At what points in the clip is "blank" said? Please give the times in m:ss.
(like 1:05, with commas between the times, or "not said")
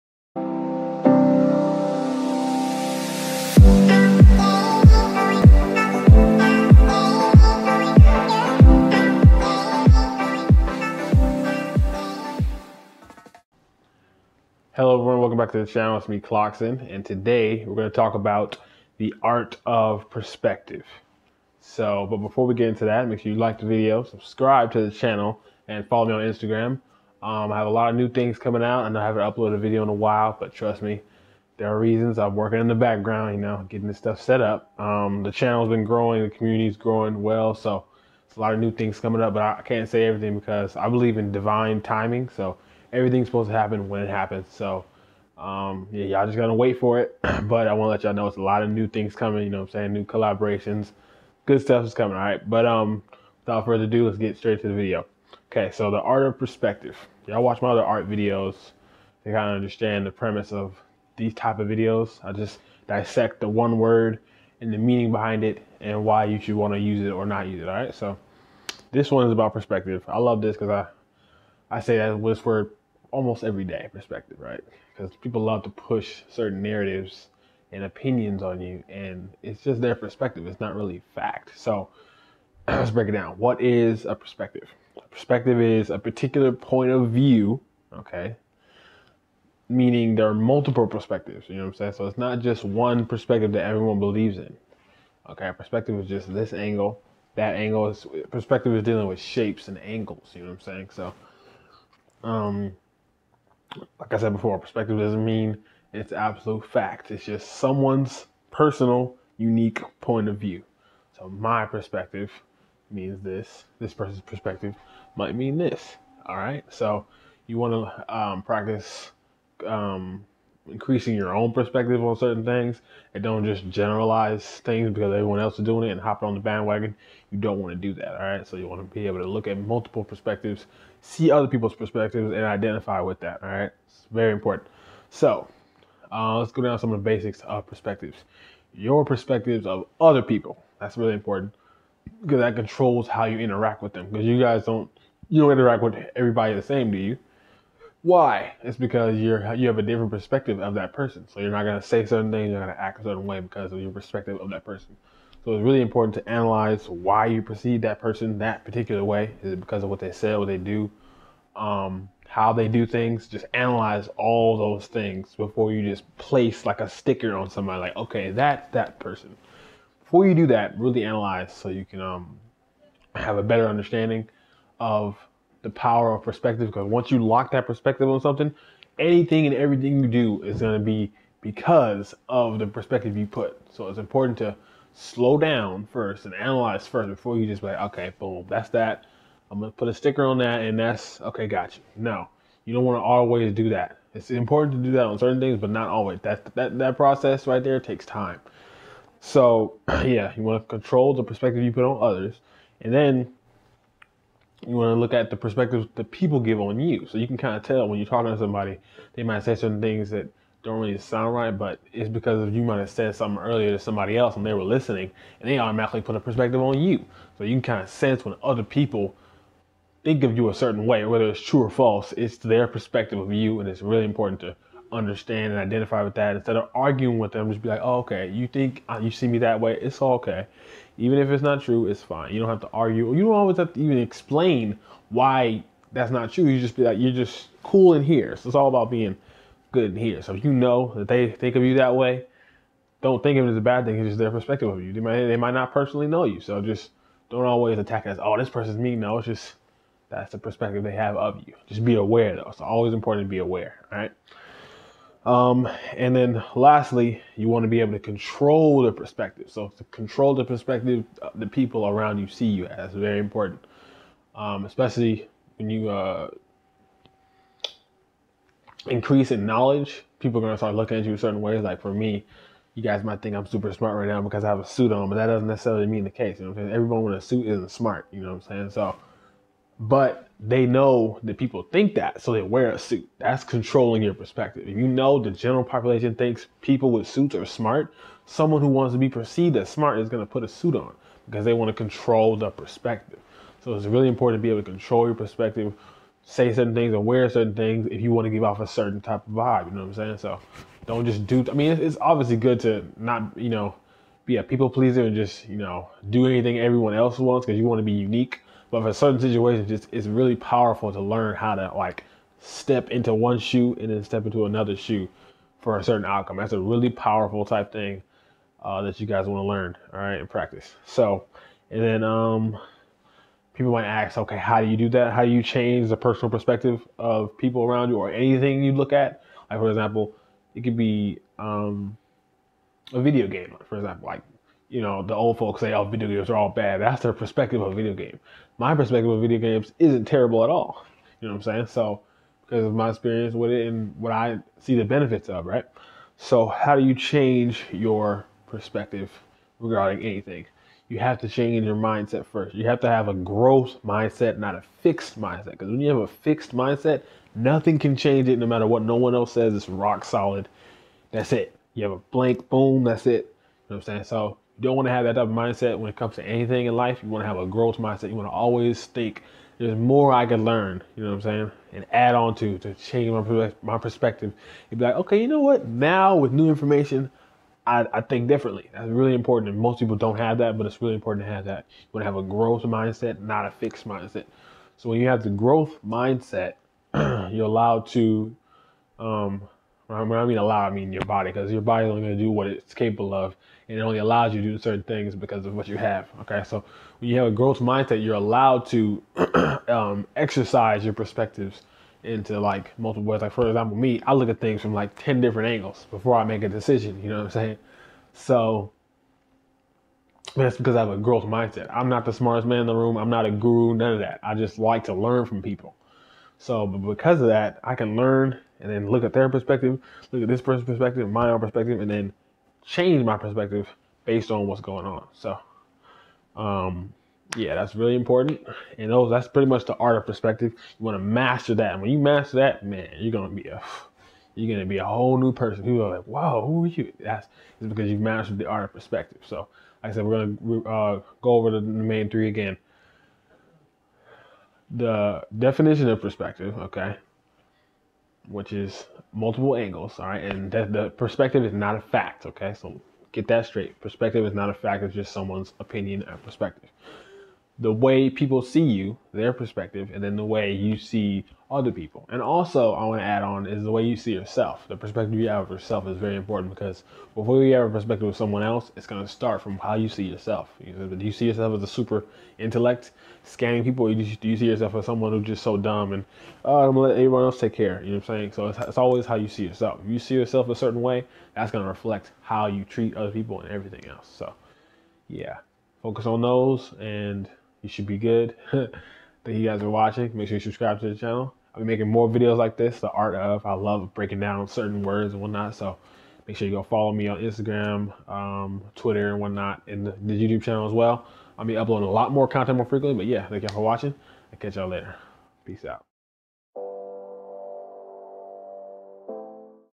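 6:01.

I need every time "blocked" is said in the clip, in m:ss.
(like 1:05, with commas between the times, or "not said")
not said.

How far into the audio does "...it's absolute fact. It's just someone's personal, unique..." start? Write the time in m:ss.
1:45.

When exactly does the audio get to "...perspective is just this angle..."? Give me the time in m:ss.
1:35.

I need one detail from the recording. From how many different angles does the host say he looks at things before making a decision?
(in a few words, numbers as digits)
10.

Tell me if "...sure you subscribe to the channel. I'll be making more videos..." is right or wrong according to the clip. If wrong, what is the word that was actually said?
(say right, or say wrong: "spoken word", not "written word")
right.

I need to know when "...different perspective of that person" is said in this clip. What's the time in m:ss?
2:29.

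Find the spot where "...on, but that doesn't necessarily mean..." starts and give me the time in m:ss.
4:34.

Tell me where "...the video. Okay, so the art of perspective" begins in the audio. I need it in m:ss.
0:54.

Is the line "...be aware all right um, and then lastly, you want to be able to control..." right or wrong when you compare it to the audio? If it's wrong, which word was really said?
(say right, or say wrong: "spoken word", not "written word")
right.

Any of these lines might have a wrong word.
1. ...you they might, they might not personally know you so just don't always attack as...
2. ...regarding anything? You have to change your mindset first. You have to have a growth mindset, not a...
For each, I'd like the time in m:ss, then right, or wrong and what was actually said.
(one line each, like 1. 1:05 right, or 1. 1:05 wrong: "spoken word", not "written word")
1. 4:04 right
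2. 5:49 right.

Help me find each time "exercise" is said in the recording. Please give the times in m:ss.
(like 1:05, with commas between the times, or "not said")
6:40.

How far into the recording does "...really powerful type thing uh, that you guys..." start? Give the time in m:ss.
5:16.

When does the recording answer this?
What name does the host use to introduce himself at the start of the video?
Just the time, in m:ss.
0:16.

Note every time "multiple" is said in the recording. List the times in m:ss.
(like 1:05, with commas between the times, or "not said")
1:30, 2:09, 6:42, 7:29.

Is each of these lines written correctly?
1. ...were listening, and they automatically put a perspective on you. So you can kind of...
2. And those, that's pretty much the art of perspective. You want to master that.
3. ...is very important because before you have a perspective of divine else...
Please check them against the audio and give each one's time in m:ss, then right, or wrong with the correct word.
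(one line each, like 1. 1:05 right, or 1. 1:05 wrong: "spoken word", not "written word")
1. 3:34 right
2. 7:08 right
3. 7:45 wrong: "someone", not "divine".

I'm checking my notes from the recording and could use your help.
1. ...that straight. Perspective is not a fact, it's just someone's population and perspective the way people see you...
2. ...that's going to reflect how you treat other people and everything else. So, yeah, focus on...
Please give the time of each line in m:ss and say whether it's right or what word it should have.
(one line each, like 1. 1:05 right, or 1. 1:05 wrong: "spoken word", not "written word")
1. 7:33 wrong: "opinion", not "population"
2. 8:01 right.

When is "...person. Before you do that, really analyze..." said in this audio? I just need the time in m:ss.
2:48.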